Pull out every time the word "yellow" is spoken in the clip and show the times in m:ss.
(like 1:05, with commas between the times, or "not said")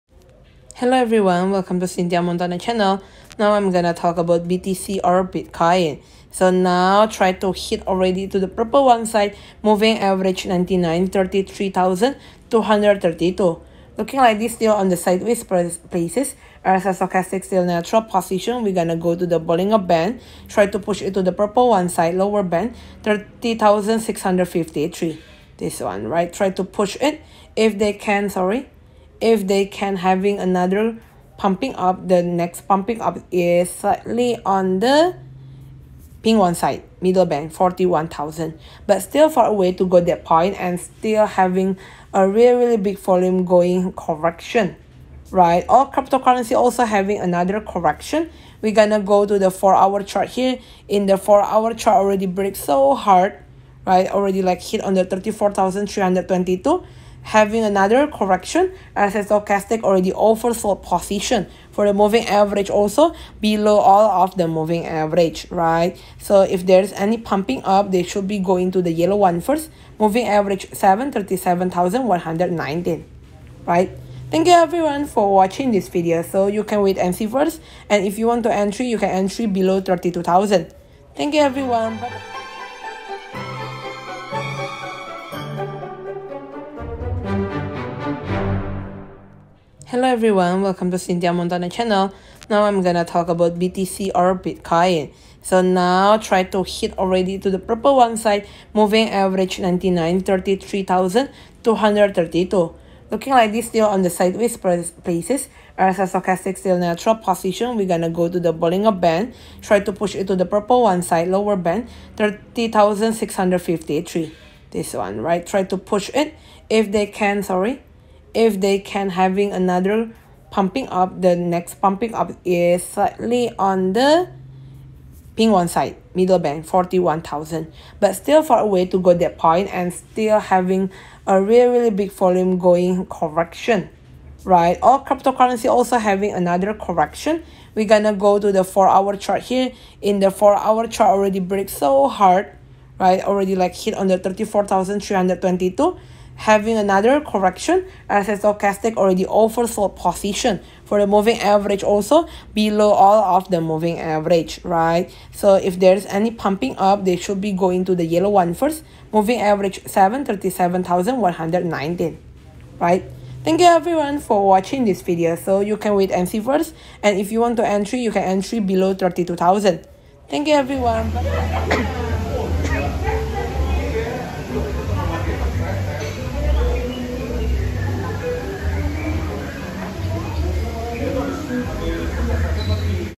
1:08, 2:38.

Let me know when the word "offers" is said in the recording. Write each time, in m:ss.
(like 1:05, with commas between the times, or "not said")
1:00, 2:29.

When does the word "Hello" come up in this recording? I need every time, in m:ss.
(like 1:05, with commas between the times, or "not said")
0:00, 1:29.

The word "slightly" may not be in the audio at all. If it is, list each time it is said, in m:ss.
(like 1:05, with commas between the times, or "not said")
0:33, 2:02.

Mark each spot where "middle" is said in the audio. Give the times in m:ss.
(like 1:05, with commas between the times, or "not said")
0:37, 2:06.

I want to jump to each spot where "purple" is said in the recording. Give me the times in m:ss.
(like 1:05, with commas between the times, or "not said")
0:08, 0:21, 1:37, 1:50.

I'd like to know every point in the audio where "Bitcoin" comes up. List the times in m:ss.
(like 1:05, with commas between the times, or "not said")
0:05, 1:34.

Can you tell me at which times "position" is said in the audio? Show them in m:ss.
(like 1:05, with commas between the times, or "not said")
0:18, 1:00, 1:47, 2:29.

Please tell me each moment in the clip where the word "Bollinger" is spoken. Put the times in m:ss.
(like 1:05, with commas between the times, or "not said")
0:19, 1:48.